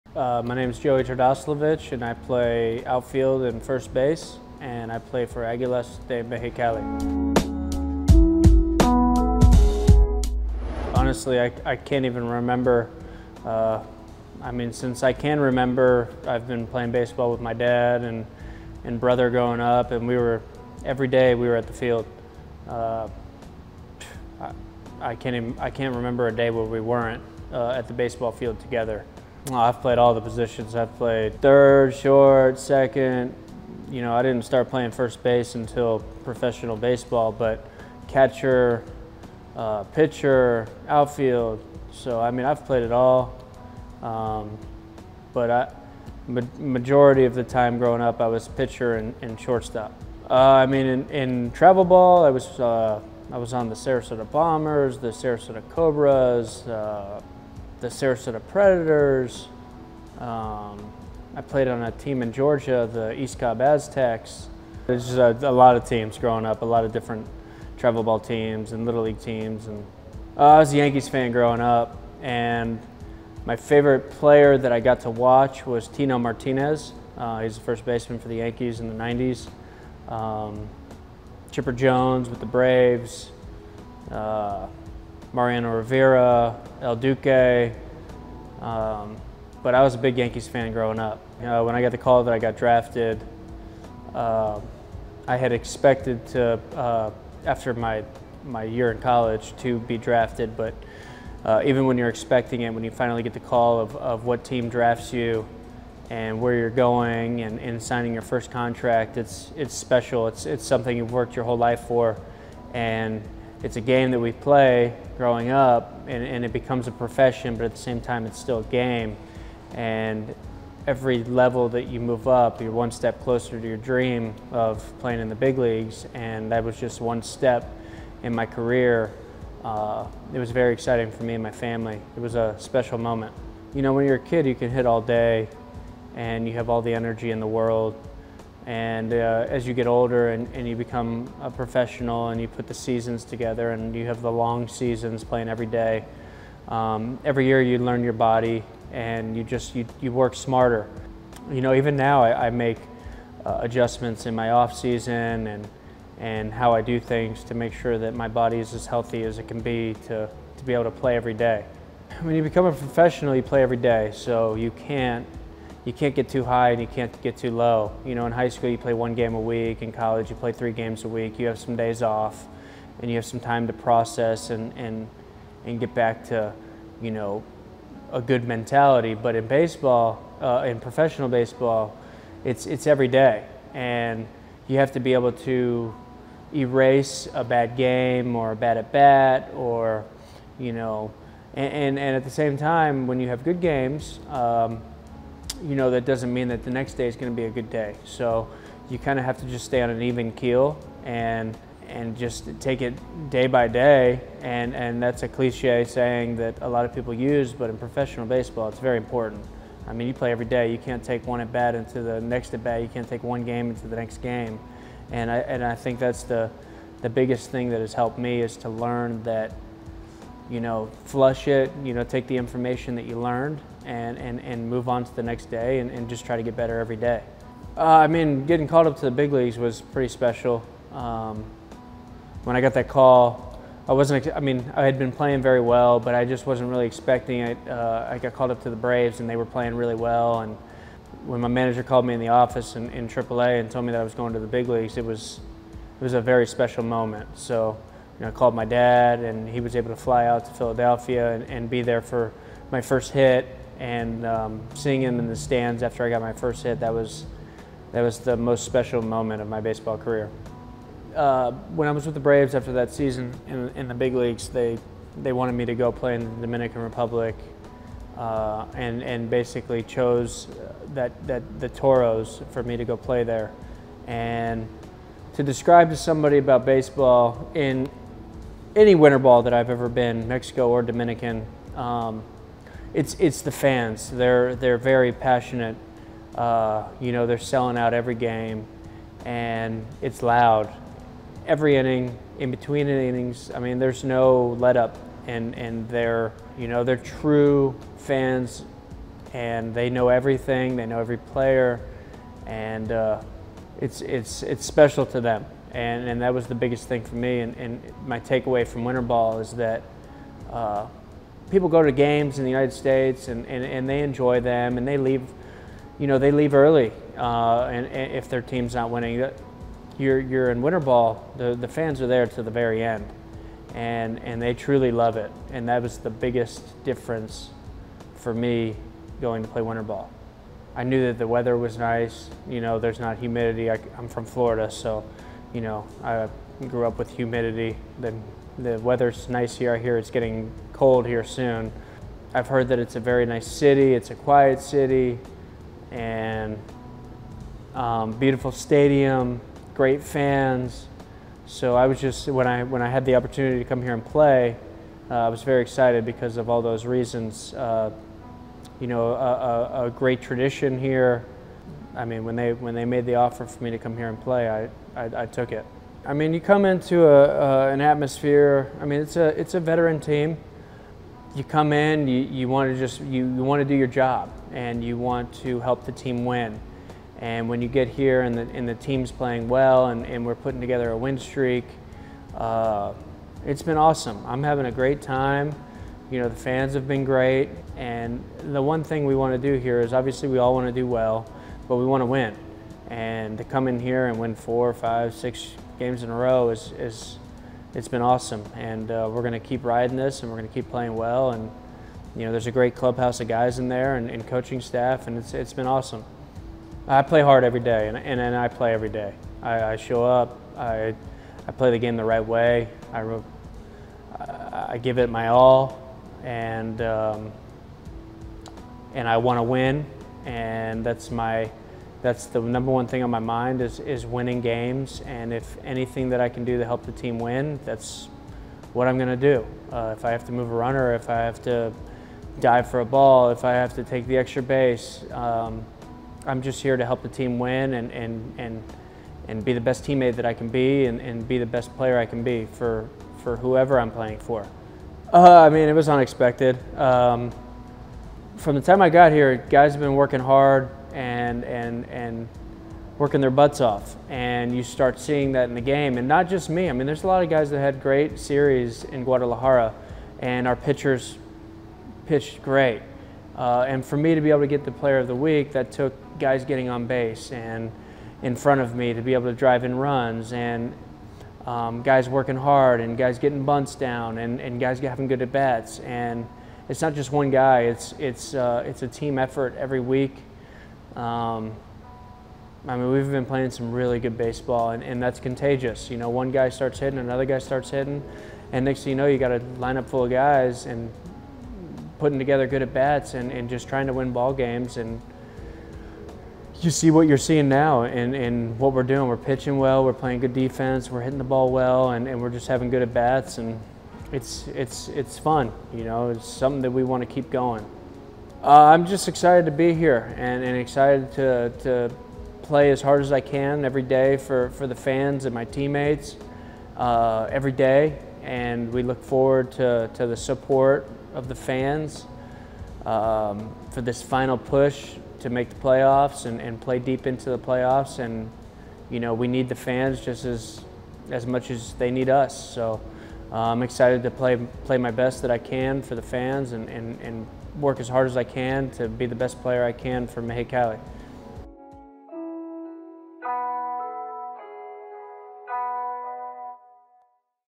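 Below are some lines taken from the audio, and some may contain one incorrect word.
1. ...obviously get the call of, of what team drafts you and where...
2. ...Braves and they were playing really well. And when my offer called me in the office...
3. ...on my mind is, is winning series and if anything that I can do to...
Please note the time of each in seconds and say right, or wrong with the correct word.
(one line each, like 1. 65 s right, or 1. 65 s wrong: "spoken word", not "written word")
1. 102 s wrong: "finally", not "obviously"
2. 238 s wrong: "manager", not "offer"
3. 423 s wrong: "games", not "series".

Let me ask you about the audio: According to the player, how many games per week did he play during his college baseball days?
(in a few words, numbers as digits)
3.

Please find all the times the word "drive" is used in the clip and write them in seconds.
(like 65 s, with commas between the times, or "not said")
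469 s.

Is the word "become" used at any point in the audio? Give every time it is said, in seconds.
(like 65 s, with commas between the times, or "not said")
116 s, 140 s, 162 s.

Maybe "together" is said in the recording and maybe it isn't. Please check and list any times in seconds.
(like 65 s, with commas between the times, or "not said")
28 s, 143 s, 380 s, 492 s.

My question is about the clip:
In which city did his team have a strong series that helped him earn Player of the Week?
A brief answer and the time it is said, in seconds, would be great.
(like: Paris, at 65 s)
Guadalajara, at 459 s.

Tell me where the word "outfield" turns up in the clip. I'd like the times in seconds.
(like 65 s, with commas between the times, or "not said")
2 s, 40 s.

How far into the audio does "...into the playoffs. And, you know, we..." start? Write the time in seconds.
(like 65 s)
527 s.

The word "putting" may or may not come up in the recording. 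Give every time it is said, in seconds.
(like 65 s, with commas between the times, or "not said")
380 s, 491 s.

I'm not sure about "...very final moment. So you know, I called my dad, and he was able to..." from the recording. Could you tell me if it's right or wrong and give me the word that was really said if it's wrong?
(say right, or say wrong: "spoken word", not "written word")
wrong: "special", not "final".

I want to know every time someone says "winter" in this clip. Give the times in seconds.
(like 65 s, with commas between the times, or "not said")
278 s, 308 s, 320 s, 329 s.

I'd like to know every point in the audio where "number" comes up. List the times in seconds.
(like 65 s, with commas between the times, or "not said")
422 s.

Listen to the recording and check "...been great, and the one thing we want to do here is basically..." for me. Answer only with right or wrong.
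wrong.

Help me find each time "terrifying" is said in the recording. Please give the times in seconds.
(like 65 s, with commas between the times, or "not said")
not said.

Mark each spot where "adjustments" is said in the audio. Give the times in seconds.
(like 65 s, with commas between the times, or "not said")
153 s.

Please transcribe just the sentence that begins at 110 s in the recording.
It's, it's something you've worked your whole life for.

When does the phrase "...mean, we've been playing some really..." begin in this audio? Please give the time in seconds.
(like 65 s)
482 s.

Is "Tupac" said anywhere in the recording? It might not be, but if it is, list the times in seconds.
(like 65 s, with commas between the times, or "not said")
not said.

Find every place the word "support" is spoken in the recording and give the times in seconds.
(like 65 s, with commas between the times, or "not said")
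520 s.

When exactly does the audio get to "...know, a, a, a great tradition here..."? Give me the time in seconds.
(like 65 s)
358 s.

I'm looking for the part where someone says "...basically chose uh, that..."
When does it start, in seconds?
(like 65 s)
269 s.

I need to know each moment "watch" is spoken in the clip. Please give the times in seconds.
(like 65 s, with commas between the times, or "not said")
75 s.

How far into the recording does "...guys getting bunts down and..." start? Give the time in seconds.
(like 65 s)
472 s.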